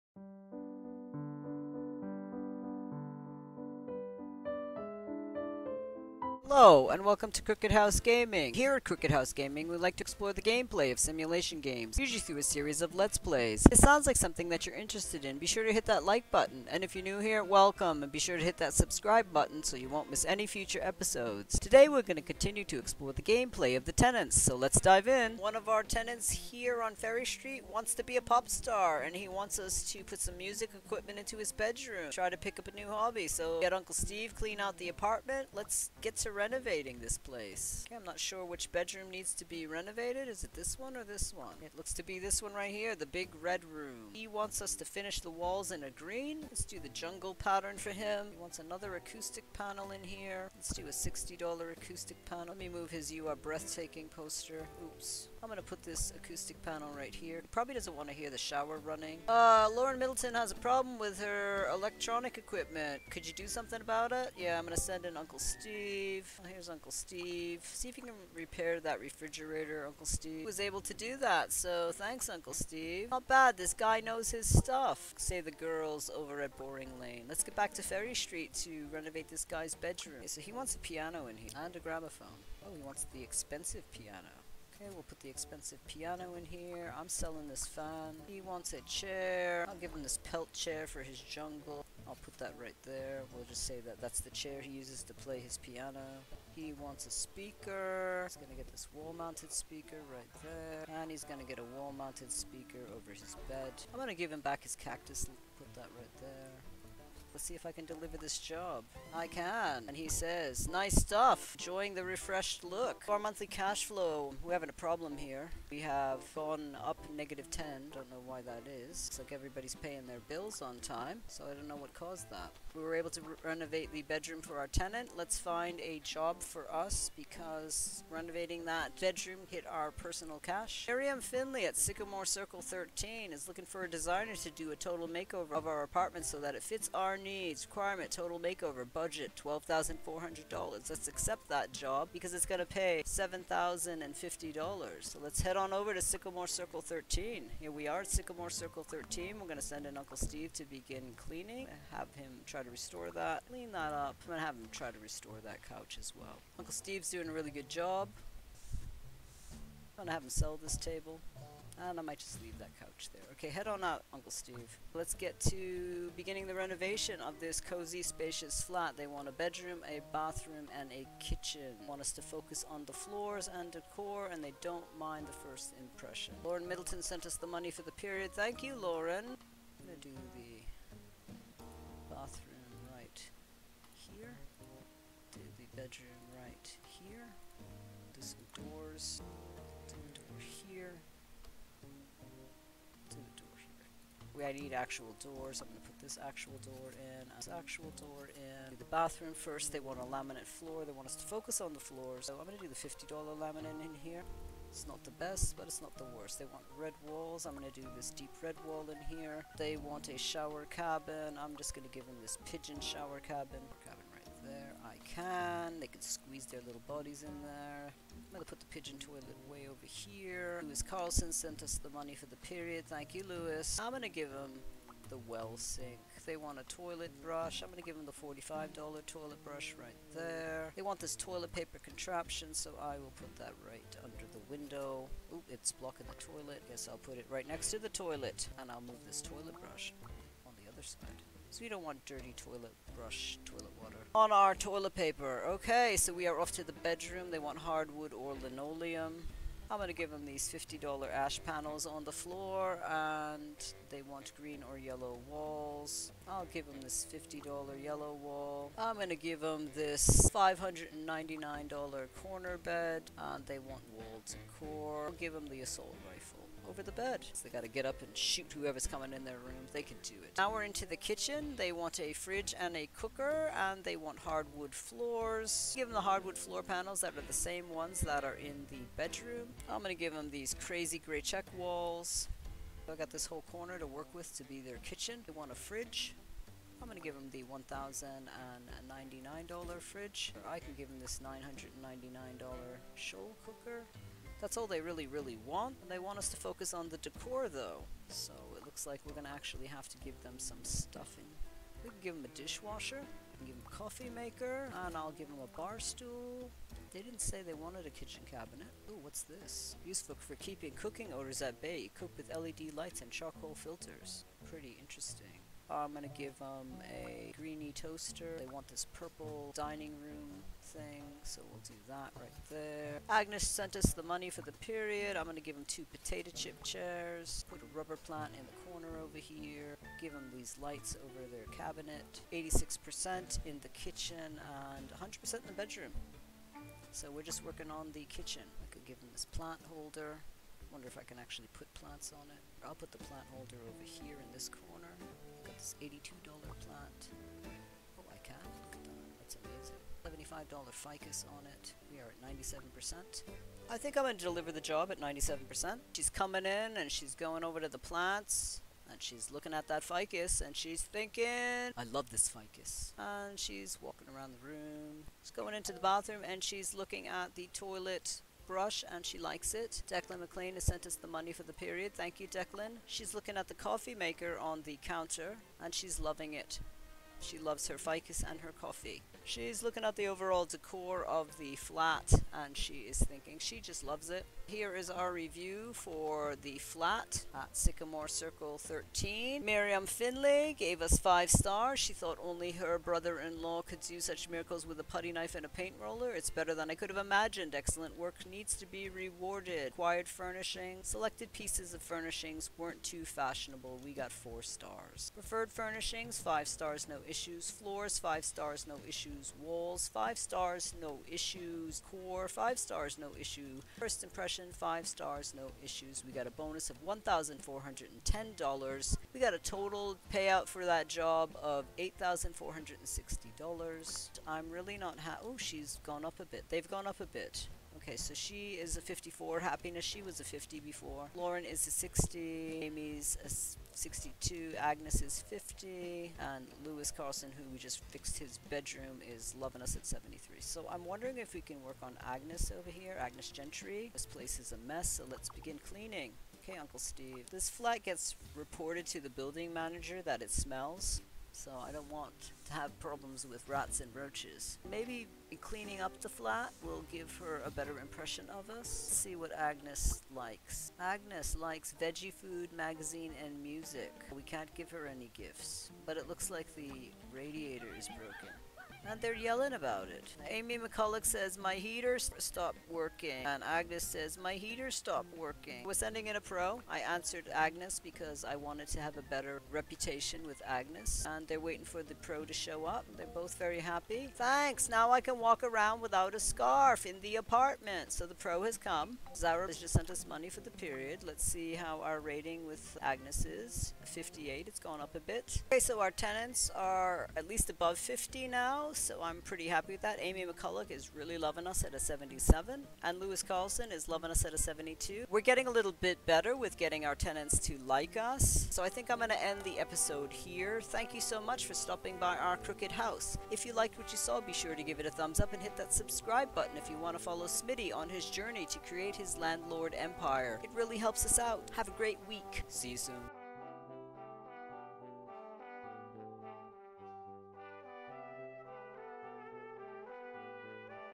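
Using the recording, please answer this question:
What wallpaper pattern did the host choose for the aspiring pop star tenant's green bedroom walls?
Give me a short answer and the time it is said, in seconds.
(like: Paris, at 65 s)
jungle pattern, at 46 s.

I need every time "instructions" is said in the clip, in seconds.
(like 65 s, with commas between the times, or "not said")
not said.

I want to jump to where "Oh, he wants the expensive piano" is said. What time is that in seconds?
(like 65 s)
82 s.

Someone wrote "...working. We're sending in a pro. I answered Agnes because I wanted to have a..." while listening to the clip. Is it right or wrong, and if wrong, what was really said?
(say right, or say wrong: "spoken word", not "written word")
right.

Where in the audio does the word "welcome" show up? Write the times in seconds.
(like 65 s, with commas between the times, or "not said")
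7 s, 17 s.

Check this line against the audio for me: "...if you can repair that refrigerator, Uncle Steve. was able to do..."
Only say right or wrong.
right.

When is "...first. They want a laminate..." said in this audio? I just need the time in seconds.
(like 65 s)
199 s.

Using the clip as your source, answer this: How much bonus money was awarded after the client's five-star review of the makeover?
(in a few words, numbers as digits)
$1,410.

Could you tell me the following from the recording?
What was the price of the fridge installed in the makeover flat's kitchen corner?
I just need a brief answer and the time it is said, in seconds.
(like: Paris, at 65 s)
$1,099, at 287 s.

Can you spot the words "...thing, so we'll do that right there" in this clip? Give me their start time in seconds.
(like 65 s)
320 s.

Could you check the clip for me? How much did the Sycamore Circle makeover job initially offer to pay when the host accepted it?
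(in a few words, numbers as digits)
$7,050.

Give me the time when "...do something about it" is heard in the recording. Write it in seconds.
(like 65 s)
63 s.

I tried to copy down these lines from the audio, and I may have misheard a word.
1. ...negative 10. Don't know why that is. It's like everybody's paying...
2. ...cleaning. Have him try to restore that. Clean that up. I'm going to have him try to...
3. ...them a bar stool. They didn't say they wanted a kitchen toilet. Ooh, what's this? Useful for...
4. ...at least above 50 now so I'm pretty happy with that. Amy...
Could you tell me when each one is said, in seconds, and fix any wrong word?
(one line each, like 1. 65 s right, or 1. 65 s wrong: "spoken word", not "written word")
1. 117 s right
2. 151 s right
3. 305 s wrong: "cabinet", not "toilet"
4. 497 s right.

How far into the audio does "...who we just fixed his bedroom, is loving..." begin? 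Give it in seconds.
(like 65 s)
437 s.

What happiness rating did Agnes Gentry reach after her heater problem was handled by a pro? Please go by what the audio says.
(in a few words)
58.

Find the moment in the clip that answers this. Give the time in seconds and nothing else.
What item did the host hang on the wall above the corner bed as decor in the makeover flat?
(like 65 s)
265 s.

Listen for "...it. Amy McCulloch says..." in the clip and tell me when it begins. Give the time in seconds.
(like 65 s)
469 s.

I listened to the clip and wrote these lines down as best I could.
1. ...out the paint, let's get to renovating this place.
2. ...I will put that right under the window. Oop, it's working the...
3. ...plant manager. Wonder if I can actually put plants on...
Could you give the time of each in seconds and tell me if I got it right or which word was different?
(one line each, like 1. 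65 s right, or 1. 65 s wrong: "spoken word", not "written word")
1. 34 s wrong: "apartment", not "paint"
2. 232 s wrong: "blocking", not "working"
3. 339 s wrong: "holder", not "manager".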